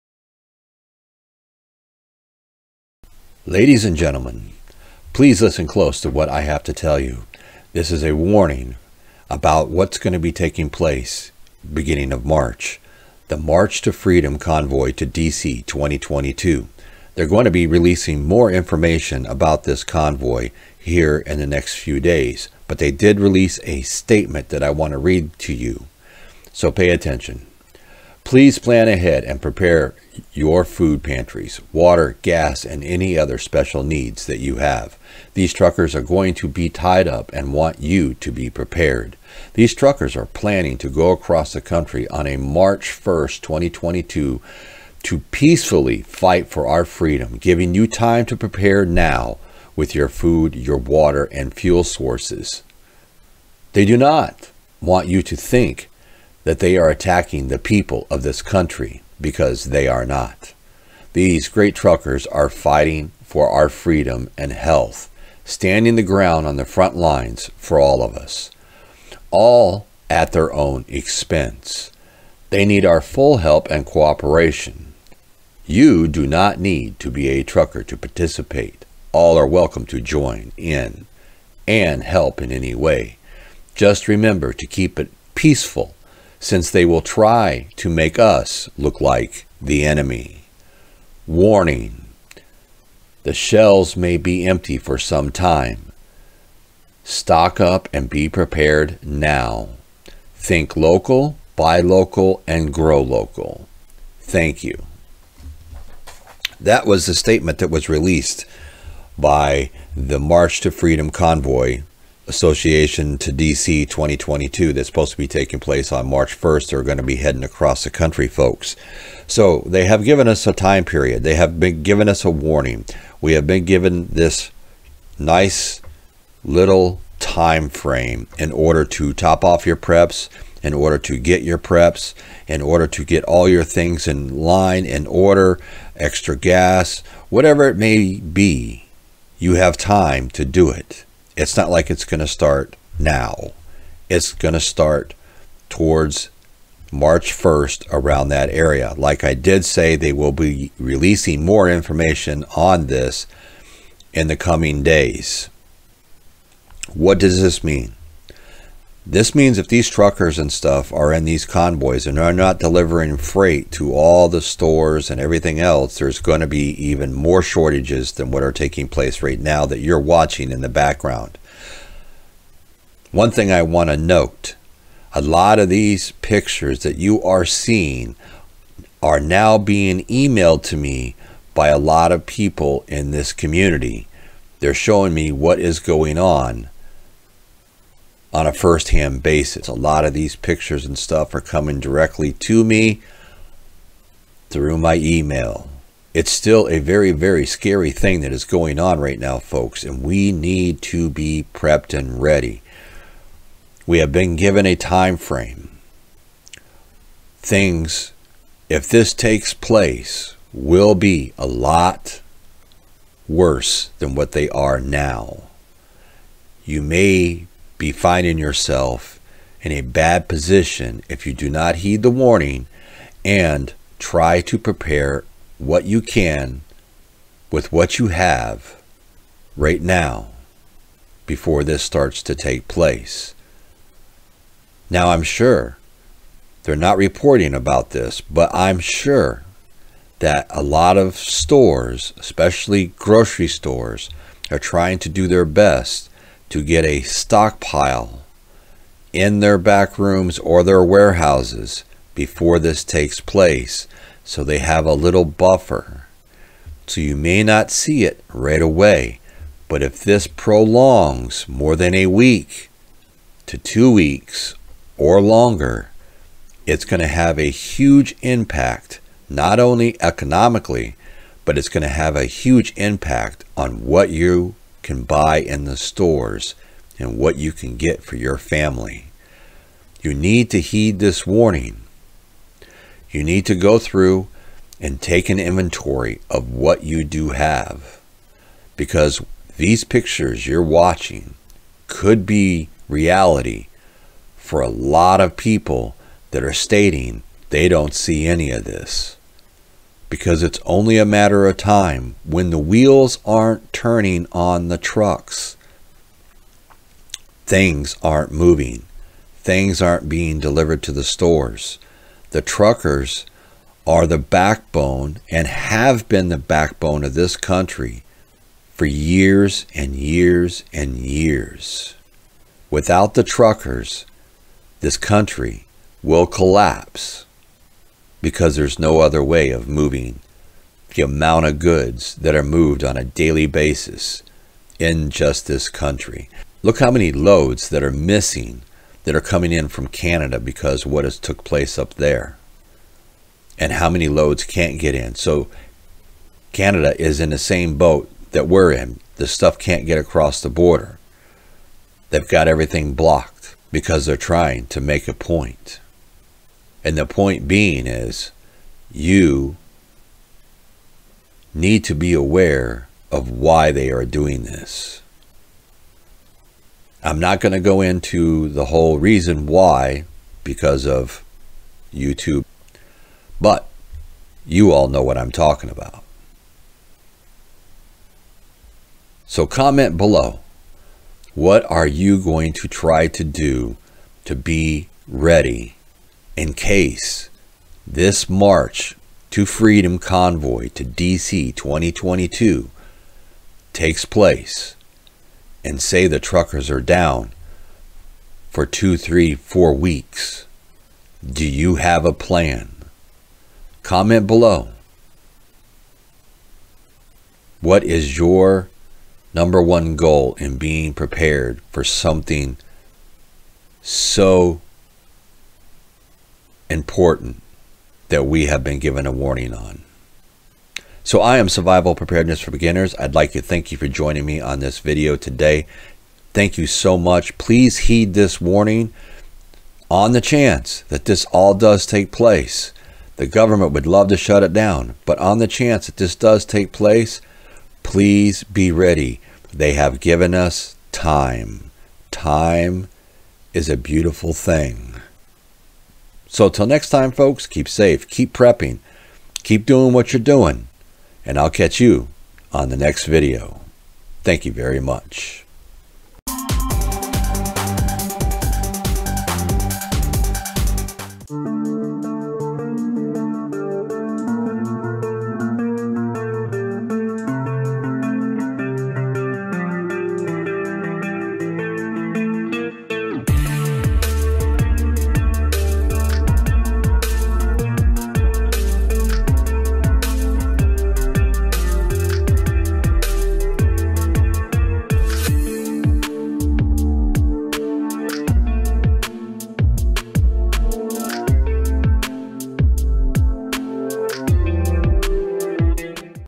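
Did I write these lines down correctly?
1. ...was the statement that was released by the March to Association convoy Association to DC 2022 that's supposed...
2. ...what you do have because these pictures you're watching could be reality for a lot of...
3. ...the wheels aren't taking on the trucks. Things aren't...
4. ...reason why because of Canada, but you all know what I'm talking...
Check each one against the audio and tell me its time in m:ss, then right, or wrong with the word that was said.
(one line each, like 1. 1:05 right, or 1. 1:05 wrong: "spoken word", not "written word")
1. 1:46 wrong: "Freedom", not "Association"
2. 4:46 right
3. 5:02 wrong: "turning", not "taking"
4. 6:08 wrong: "YouTube", not "Canada".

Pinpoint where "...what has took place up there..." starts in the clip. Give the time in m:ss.
5:40.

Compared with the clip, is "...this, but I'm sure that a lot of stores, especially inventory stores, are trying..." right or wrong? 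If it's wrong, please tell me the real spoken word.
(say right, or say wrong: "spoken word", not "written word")
wrong: "grocery", not "inventory".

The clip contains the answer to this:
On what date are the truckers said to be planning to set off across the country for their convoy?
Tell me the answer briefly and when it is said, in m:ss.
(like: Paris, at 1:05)
March 1st, 2022, at 0:42.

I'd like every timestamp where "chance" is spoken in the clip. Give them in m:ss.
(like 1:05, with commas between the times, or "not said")
7:10, 7:15.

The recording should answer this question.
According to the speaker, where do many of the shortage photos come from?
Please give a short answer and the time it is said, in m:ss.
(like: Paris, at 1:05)
Email, at 3:14.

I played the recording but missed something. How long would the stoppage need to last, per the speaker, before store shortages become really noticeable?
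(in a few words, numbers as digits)
A week to two weeks.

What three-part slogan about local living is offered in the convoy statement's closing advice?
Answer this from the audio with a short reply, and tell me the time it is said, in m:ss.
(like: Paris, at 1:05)
Think local, buy local, and grow local, at 1:40.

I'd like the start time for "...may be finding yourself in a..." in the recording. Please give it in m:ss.
3:36.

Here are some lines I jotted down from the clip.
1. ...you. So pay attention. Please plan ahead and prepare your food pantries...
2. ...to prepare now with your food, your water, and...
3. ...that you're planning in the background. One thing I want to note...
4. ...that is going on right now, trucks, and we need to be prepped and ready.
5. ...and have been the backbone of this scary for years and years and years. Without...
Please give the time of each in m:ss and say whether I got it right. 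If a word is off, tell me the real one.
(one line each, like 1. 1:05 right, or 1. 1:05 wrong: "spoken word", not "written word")
1. 0:25 right
2. 0:48 right
3. 2:49 wrong: "watching", not "planning"
4. 3:18 wrong: "folks", not "trucks"
5. 5:15 wrong: "country", not "scary".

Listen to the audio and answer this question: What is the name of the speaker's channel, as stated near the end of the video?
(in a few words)
Survival Preparedness for Beginners.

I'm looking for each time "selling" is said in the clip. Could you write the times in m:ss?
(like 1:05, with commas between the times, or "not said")
not said.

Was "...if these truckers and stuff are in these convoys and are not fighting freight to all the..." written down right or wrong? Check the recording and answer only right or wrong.
wrong.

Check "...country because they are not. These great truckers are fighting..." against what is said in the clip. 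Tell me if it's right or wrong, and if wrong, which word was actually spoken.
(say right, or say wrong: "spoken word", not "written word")
right.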